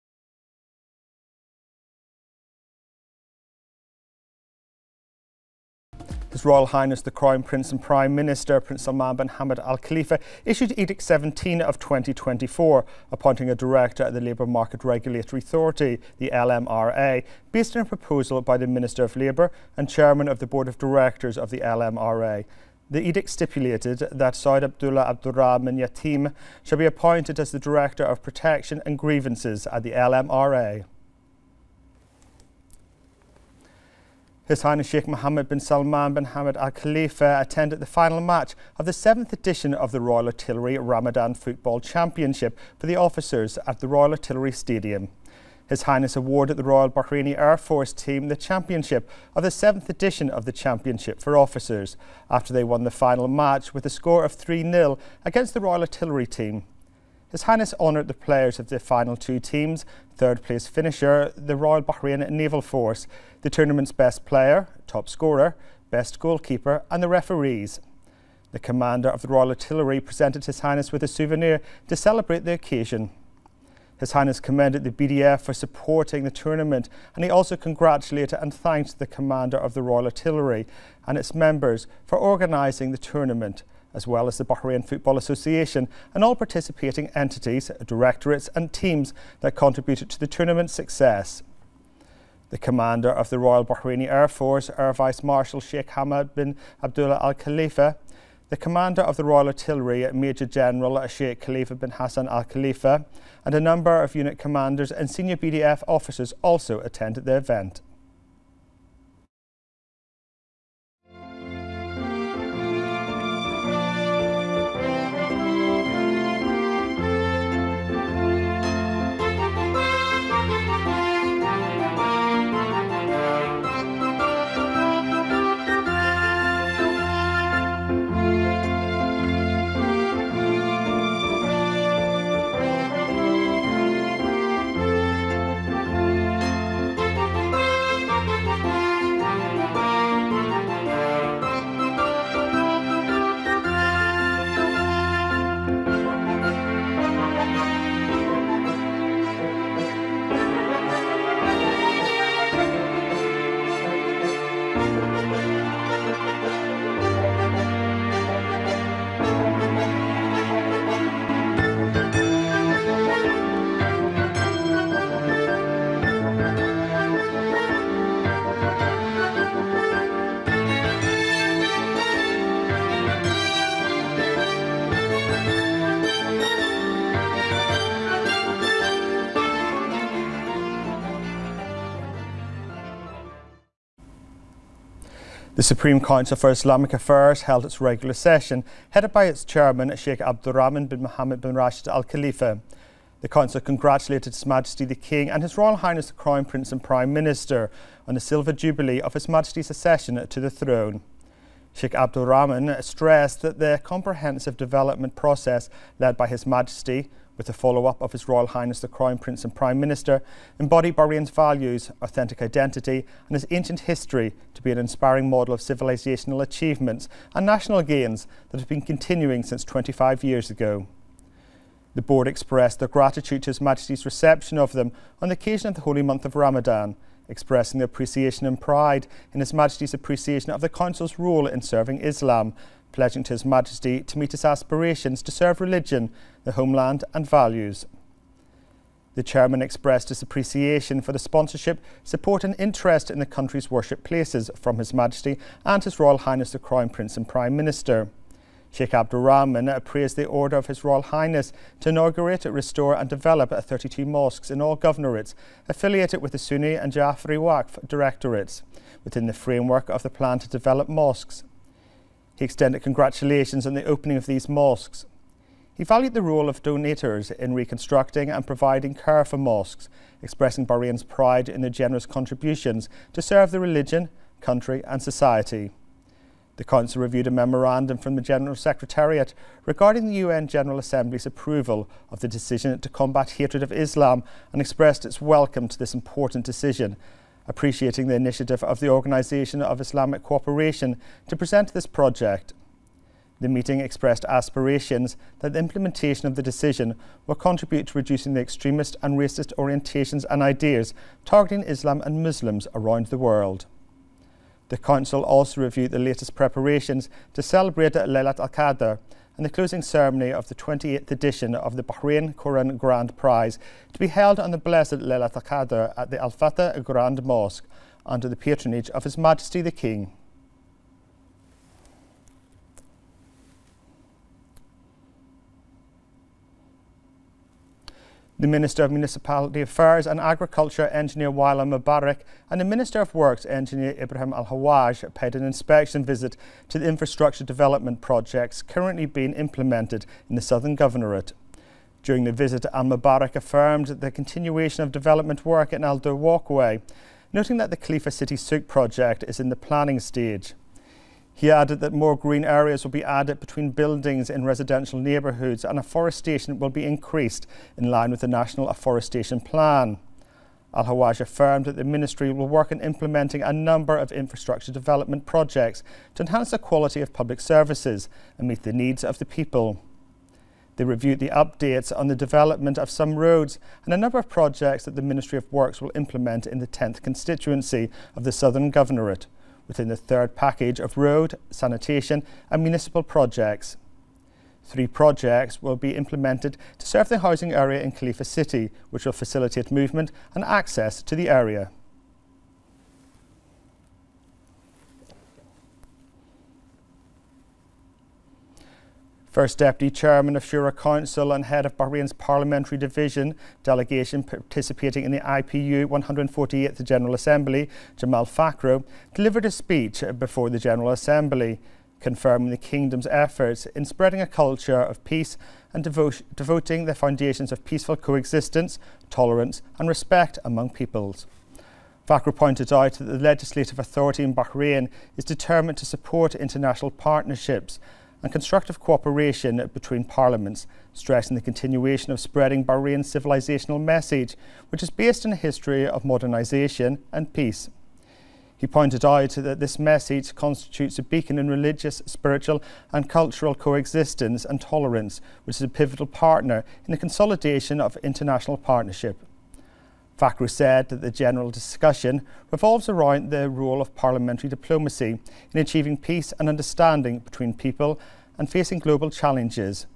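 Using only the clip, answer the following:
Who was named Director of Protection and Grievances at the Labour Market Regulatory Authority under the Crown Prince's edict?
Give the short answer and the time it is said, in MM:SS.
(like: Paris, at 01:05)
Saud Abdullah Abdurrahman Yatim, at 00:24.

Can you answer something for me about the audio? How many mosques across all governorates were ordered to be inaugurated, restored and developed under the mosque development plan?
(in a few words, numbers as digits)
32.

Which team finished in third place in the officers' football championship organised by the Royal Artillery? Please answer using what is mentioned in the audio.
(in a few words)
Royal Bahrain Naval Force.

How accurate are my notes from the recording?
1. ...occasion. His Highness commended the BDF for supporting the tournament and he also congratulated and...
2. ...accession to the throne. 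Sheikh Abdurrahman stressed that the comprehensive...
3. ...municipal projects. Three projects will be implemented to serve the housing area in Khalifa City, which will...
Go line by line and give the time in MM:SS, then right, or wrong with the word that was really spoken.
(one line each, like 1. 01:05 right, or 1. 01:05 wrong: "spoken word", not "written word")
1. 01:12 right
2. 03:19 right
3. 06:22 right.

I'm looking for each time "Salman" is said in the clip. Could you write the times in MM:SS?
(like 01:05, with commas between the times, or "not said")
00:08, 00:35.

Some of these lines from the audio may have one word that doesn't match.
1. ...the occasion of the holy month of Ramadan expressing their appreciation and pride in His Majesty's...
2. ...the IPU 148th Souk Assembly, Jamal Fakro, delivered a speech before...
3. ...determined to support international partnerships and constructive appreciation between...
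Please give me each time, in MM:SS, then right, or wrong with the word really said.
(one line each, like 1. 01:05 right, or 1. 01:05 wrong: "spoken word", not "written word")
1. 03:45 right
2. 06:45 wrong: "General", not "Souk"
3. 07:05 wrong: "cooperation", not "appreciation".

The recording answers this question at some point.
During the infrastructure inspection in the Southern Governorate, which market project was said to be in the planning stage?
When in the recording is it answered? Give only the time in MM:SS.
05:47.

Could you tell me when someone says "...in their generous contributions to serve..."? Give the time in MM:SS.
04:31.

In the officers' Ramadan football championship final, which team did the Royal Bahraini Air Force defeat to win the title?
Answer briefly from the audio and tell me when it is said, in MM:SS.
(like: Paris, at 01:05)
Royal Artillery team, at 00:55.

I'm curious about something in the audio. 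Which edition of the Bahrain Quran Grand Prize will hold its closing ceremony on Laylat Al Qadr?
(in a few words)
28th.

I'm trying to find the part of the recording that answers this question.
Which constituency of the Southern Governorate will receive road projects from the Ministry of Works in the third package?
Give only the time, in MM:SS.
06:16.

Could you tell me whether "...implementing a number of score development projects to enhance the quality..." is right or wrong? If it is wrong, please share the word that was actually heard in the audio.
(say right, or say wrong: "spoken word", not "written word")
wrong: "infrastructure", not "score".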